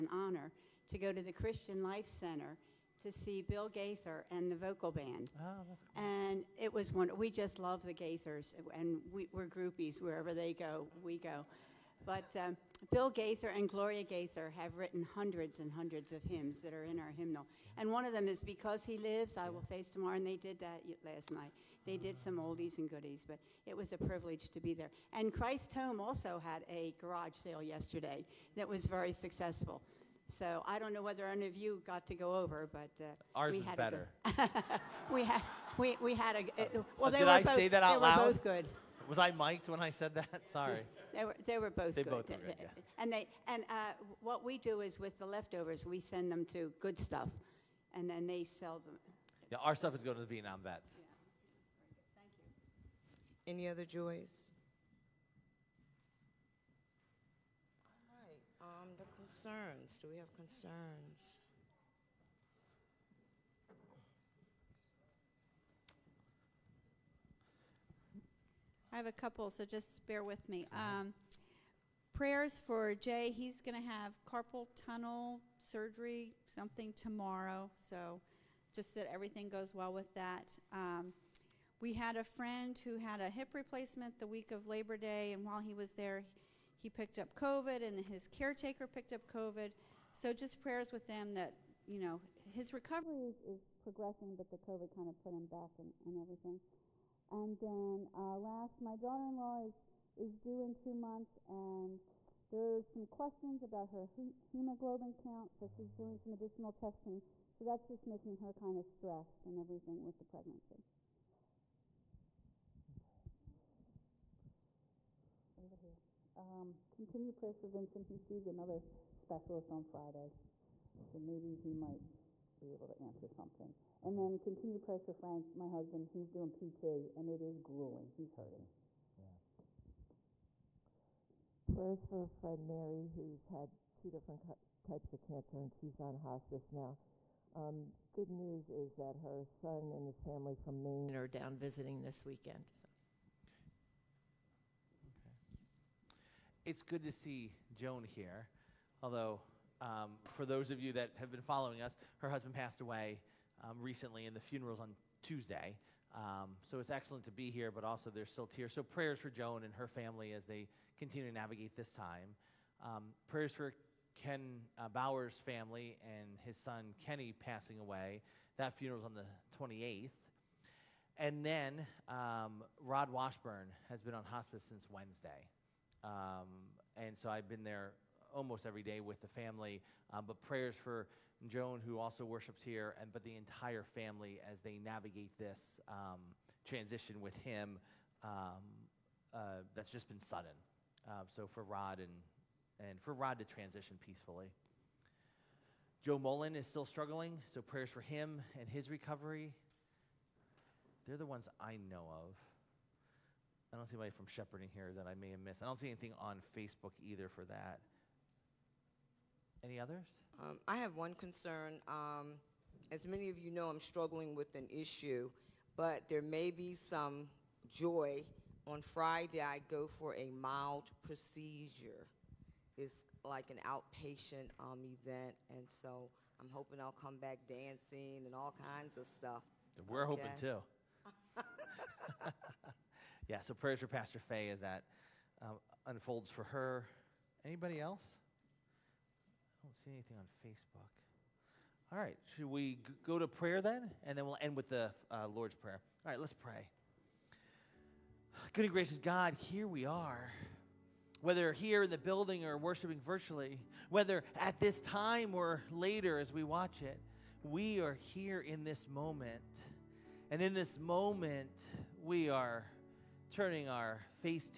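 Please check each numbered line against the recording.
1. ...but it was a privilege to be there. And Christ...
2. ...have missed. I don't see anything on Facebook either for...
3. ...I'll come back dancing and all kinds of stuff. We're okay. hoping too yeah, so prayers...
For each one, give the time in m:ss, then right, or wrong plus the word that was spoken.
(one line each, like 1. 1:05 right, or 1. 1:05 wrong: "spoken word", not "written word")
1. 0:23 right
2. 3:25 right
3. 3:46 right.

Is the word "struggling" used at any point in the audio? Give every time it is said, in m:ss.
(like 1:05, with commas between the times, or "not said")
3:16, 3:33.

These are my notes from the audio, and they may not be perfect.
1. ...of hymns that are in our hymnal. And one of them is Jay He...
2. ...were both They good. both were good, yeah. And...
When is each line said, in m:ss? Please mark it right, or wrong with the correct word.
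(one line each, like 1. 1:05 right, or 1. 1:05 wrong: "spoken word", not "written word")
1. 0:16 wrong: "Because", not "Jay"
2. 0:41 right.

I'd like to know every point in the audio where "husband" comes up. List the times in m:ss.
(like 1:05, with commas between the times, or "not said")
2:05, 2:32.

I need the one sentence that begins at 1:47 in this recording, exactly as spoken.
So that's just making her kind of stressed and everything with the pregnancy.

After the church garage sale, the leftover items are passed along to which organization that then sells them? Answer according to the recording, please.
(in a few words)
Good Stuff.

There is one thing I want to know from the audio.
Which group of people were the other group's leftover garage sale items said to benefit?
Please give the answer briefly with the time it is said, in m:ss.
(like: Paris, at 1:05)
Vietnam vets, at 0:50.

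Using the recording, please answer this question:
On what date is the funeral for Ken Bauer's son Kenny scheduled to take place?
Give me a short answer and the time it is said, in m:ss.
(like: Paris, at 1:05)
the 28th, at 2:49.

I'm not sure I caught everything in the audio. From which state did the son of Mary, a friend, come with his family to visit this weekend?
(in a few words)
Maine.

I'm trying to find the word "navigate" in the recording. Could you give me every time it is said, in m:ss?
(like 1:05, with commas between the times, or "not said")
2:41, 3:04.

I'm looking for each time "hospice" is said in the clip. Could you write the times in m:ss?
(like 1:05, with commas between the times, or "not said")
2:16, 2:54.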